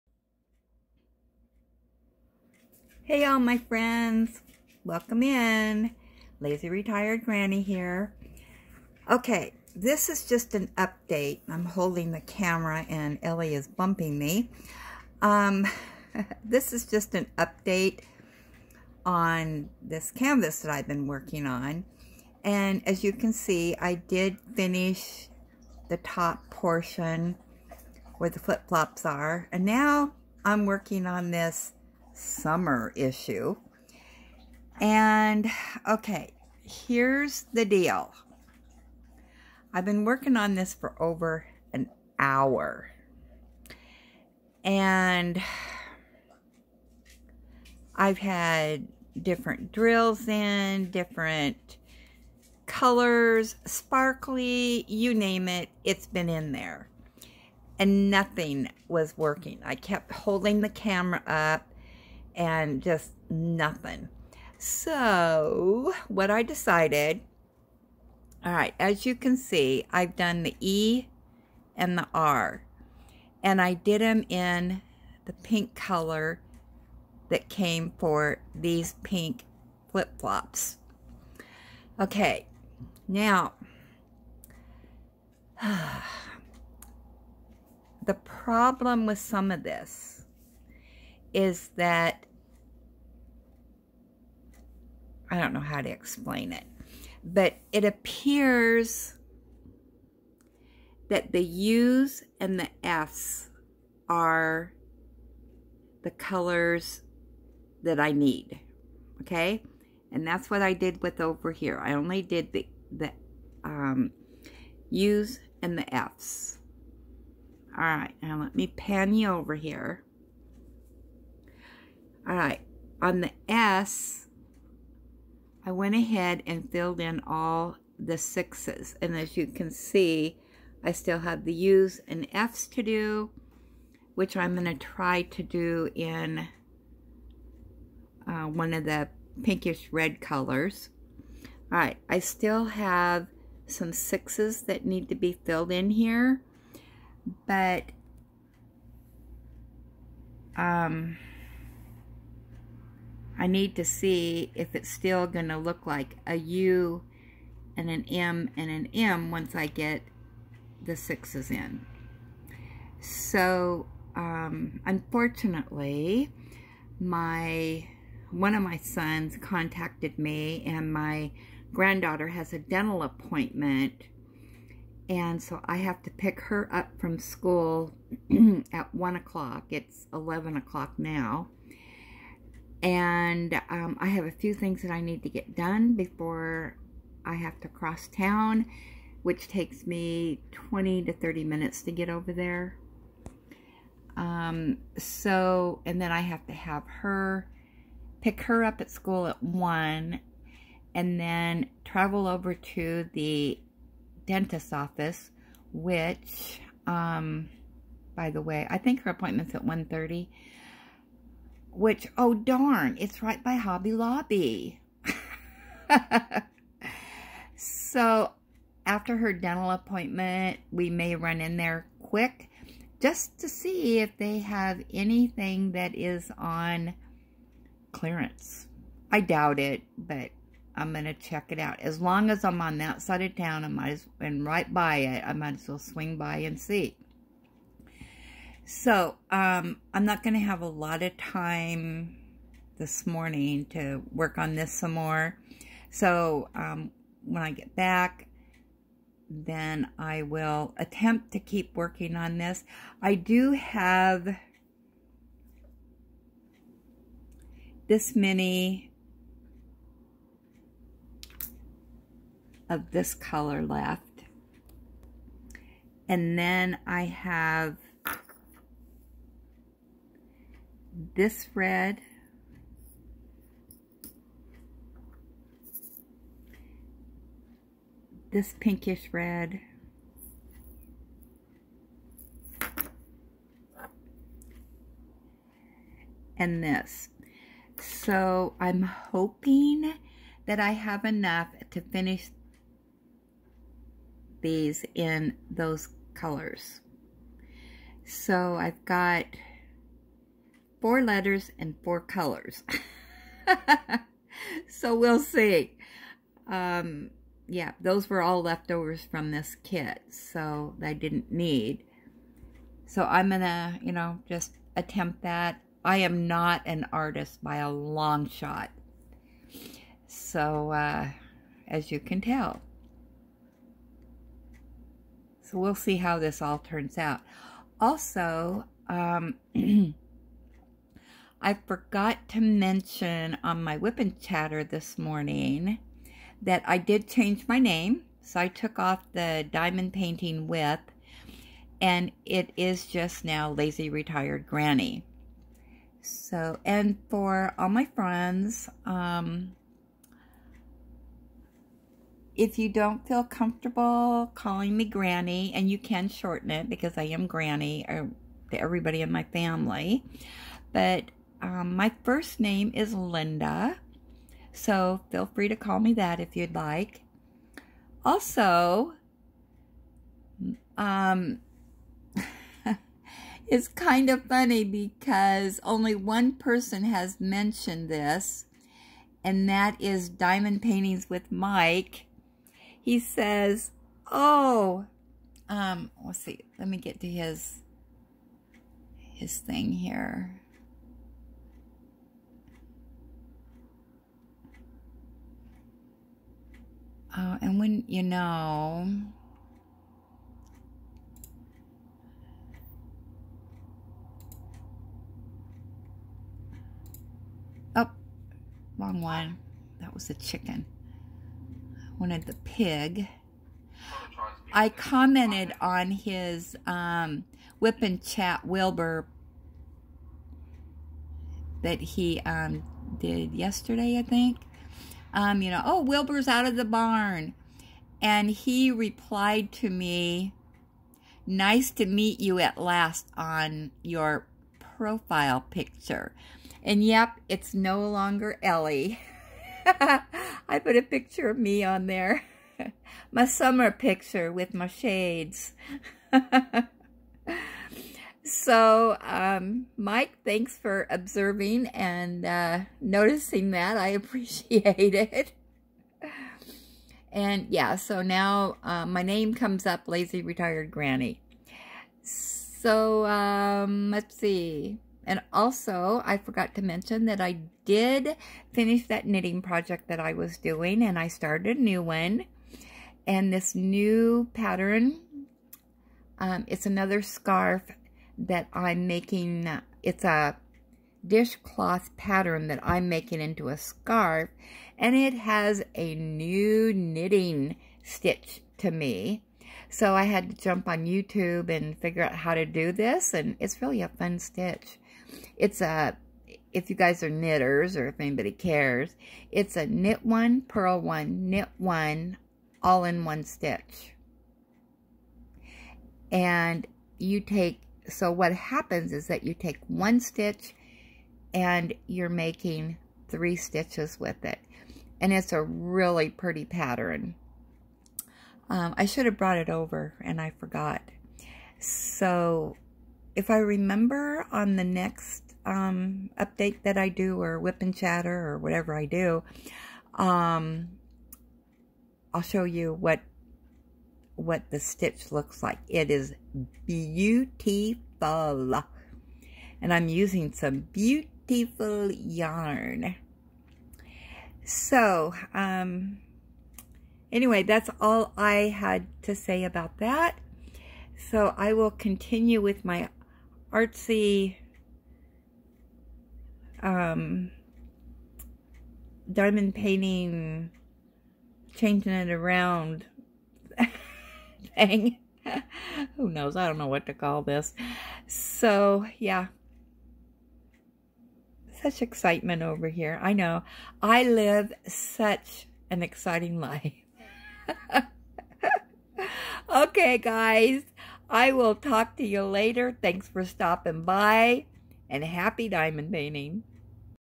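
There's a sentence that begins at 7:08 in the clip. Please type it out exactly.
And he replied to me, nice to meet you at last on your profile picture.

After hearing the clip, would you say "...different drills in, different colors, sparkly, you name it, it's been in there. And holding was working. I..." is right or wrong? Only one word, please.
wrong.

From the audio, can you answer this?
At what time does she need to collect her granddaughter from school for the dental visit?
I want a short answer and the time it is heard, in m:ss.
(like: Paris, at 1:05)
1 o'clock, at 2:58.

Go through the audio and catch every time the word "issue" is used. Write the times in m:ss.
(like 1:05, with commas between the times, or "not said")
0:32.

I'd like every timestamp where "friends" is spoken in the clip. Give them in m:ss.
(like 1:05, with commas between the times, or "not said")
0:03, 5:47.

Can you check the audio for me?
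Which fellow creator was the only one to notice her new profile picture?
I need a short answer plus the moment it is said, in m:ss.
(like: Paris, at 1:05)
Diamond Paintings with Mike, at 6:20.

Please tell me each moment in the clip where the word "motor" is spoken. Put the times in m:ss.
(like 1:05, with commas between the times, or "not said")
not said.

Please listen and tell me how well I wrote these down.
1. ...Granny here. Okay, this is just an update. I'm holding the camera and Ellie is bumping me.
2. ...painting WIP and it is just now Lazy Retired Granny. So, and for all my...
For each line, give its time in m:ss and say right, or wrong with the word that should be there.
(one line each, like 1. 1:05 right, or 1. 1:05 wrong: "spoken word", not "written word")
1. 0:07 right
2. 5:39 right.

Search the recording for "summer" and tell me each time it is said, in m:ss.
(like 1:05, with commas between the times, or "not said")
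0:32, 7:23.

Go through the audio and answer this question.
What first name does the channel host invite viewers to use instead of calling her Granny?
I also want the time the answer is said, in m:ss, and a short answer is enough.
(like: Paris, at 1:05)
Linda, at 6:02.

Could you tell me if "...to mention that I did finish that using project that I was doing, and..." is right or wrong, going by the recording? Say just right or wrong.
wrong.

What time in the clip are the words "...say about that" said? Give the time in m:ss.
9:09.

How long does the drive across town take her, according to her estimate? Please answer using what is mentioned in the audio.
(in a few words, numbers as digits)
20 to 30 minutes.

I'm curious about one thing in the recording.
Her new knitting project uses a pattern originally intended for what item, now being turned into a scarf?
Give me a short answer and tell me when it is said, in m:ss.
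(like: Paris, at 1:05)
dishcloth, at 8:01.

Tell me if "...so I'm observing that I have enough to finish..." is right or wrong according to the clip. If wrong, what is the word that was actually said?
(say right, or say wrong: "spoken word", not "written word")
wrong: "hoping", not "observing".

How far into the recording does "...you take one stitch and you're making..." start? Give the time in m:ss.
8:29.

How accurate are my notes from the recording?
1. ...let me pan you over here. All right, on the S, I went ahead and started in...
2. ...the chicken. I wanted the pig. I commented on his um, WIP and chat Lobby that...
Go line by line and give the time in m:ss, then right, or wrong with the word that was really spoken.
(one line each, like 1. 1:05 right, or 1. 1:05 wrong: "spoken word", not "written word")
1. 1:58 wrong: "filled", not "started"
2. 6:50 wrong: "Wilbur", not "Lobby".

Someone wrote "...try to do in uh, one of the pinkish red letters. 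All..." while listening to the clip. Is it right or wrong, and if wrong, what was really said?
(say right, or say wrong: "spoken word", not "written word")
wrong: "colors", not "letters".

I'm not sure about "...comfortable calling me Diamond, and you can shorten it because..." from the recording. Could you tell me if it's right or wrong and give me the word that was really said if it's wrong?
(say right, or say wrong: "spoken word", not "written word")
wrong: "Granny", not "Diamond".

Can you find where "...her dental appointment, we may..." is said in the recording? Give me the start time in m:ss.
3:39.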